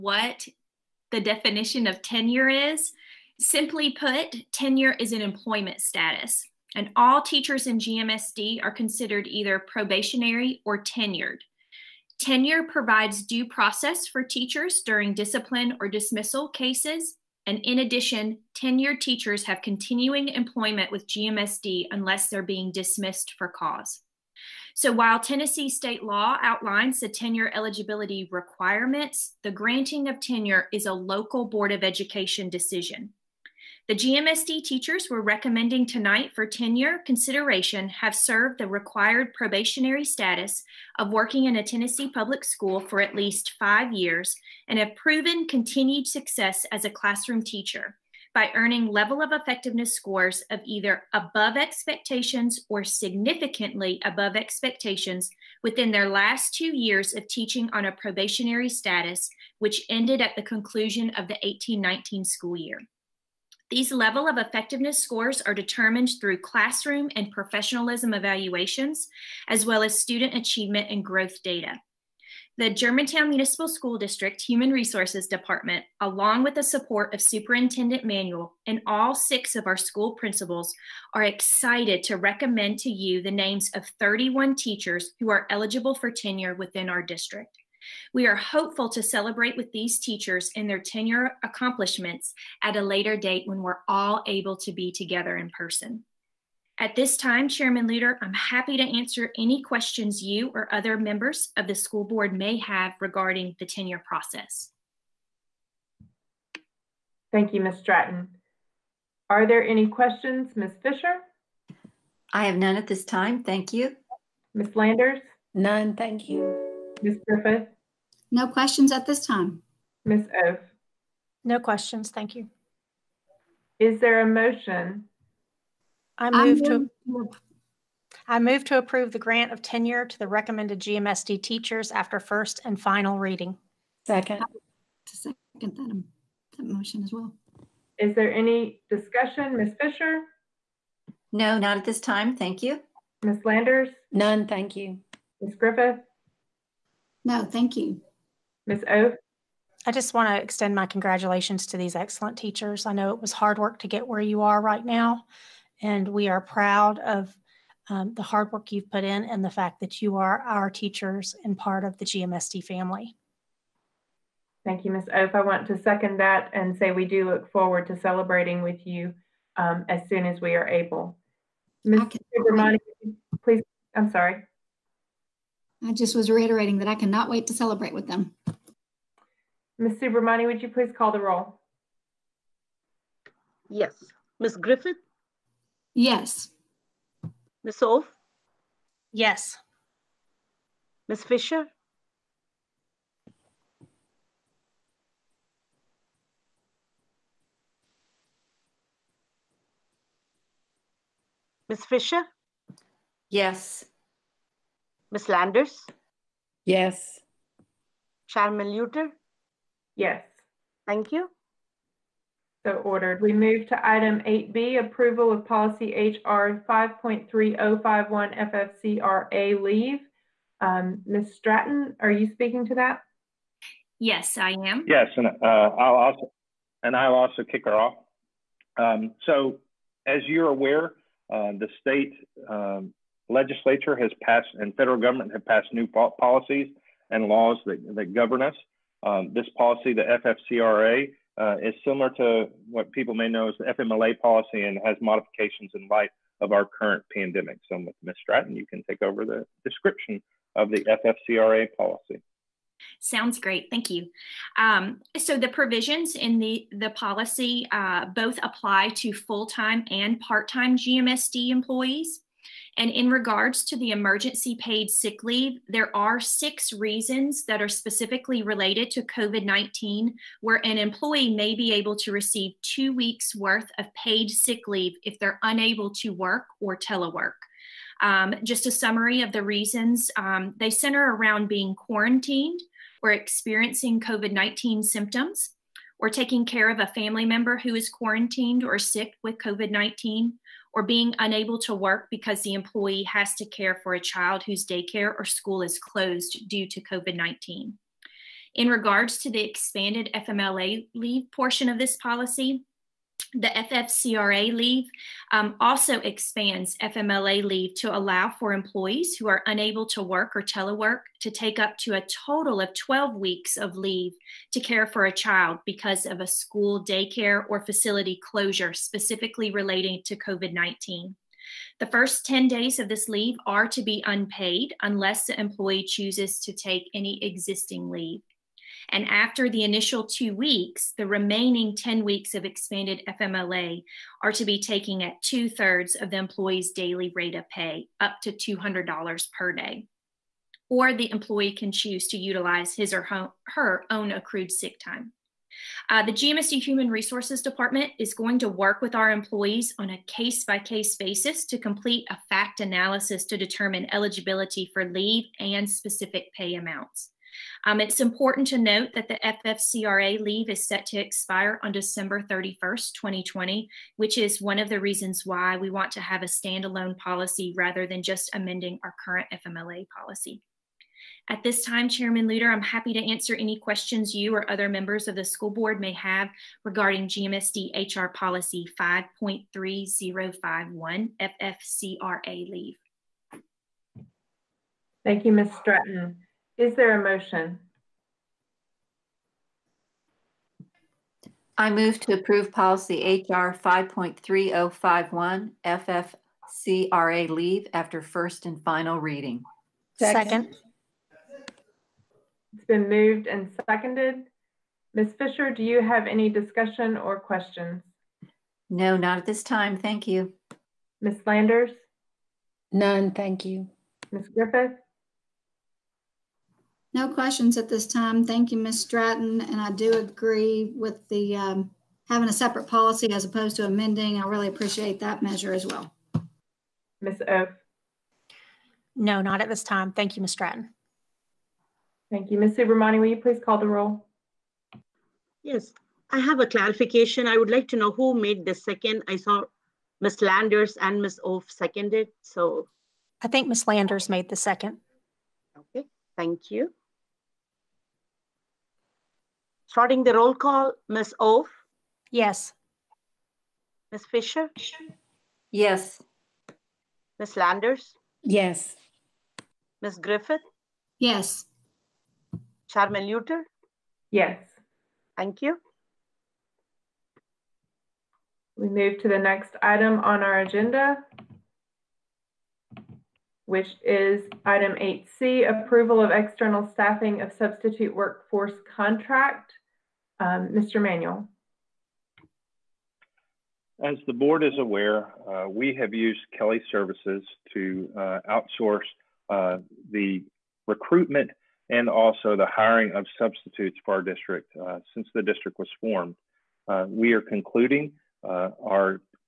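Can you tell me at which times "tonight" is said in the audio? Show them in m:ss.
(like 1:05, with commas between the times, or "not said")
0:35.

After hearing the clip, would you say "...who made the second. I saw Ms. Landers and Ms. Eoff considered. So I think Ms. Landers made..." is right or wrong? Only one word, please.
wrong.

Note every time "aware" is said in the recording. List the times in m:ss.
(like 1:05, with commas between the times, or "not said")
3:50, 8:04.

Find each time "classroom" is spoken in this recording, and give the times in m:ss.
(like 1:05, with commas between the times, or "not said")
0:46, 1:06.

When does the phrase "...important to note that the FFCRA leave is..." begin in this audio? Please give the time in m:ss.
5:57.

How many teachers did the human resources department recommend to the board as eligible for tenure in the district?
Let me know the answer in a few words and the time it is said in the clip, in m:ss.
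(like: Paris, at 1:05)
31, at 1:23.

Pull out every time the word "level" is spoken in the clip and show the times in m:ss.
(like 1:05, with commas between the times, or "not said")
0:48, 1:03.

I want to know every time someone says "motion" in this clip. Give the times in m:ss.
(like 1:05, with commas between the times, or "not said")
2:04, 2:16, 6:27.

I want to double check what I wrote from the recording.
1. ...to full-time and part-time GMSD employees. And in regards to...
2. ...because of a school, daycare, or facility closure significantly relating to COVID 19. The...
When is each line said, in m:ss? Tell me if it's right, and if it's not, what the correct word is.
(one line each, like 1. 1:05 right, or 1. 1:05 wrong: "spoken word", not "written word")
1. 4:18 right
2. 5:15 wrong: "specifically", not "significantly".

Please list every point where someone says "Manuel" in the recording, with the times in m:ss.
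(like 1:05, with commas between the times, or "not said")
1:18, 8:00.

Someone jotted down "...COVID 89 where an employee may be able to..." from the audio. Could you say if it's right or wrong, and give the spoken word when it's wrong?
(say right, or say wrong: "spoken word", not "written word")
wrong: "19", not "89".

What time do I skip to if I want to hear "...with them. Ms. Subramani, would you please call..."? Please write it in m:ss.
2:57.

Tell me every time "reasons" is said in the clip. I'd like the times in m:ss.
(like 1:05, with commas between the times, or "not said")
4:26, 4:39, 6:04.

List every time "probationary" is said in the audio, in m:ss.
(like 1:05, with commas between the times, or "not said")
0:09, 0:39, 0:57.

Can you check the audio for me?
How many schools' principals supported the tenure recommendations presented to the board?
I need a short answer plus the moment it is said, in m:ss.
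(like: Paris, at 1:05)
6, at 1:18.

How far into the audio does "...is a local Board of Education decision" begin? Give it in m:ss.
0:30.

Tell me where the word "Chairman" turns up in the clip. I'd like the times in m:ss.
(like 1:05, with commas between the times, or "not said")
1:37, 3:28, 6:11, 7:42.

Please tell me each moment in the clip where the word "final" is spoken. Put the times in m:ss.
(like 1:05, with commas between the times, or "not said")
2:12, 6:38.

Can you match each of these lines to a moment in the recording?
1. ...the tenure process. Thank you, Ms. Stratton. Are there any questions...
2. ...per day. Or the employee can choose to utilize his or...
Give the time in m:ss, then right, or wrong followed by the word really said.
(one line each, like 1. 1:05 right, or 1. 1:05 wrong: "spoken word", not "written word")
1. 1:43 right
2. 5:39 right.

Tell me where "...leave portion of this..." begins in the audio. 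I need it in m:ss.
5:00.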